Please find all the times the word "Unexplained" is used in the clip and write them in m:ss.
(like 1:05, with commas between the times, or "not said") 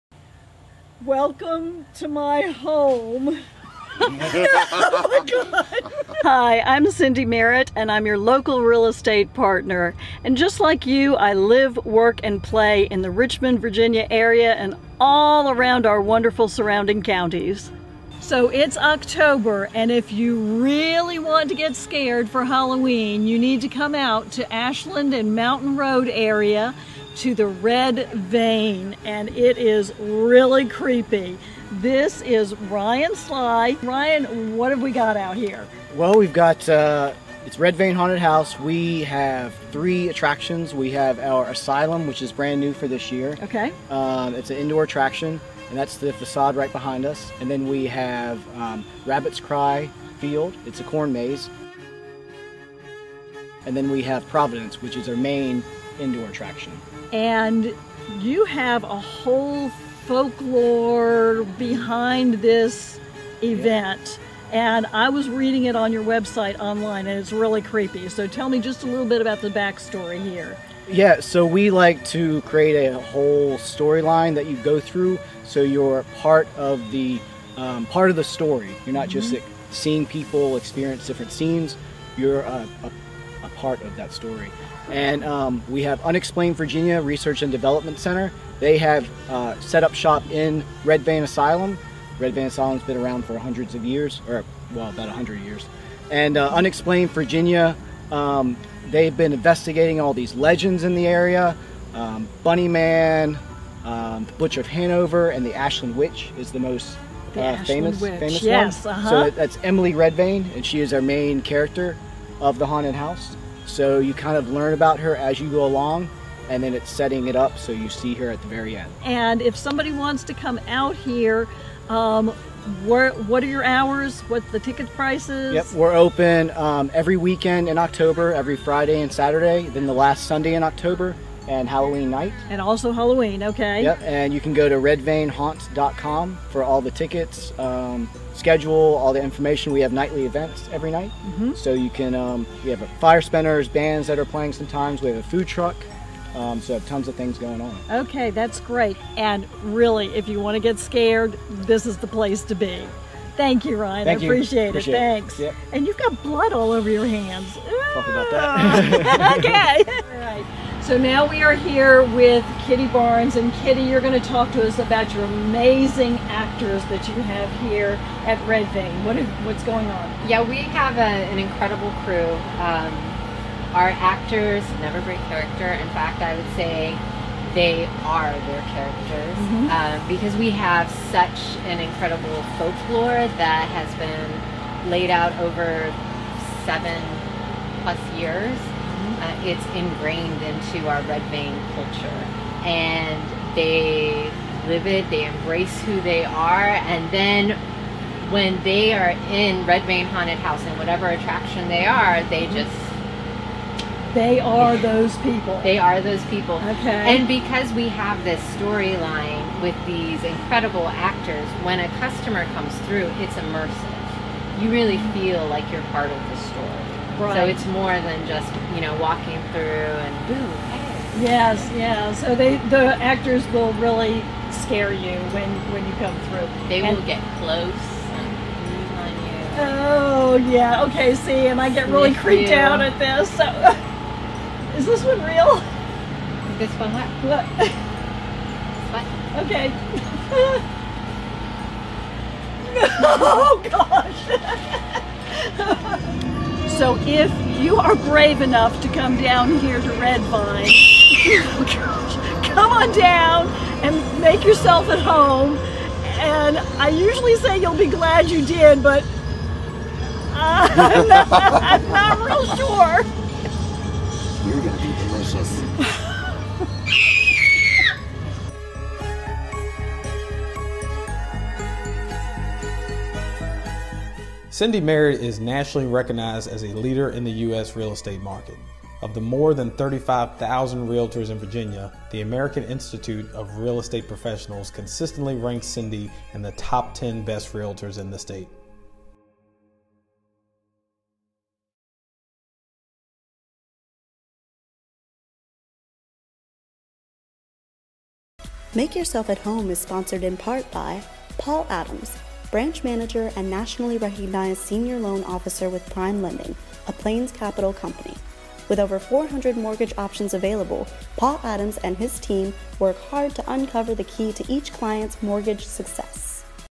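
1:26, 1:36.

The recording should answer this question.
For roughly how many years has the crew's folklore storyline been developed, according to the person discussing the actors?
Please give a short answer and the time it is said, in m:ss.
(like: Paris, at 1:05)
7 plus years, at 3:06.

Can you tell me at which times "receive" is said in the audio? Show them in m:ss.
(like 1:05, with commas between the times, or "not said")
not said.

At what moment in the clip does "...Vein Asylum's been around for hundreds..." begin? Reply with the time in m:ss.
1:32.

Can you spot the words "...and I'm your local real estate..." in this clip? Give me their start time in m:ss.
0:07.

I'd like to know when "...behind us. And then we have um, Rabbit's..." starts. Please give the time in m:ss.
0:46.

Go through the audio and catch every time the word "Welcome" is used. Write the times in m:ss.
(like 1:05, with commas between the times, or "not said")
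0:01.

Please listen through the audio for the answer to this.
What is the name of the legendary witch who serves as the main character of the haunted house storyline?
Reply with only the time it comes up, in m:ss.
1:49.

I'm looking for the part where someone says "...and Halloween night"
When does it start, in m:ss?
2:11.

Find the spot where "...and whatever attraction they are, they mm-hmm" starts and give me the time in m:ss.
3:20.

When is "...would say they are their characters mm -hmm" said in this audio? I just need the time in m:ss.
2:56.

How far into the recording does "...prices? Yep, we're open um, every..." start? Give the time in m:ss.
2:04.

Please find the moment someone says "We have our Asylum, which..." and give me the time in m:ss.
0:40.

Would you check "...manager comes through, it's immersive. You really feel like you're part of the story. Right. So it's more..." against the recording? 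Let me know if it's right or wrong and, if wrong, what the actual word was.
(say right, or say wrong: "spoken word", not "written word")
wrong: "customer", not "manager".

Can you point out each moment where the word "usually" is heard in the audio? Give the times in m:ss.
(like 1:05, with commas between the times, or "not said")
4:16.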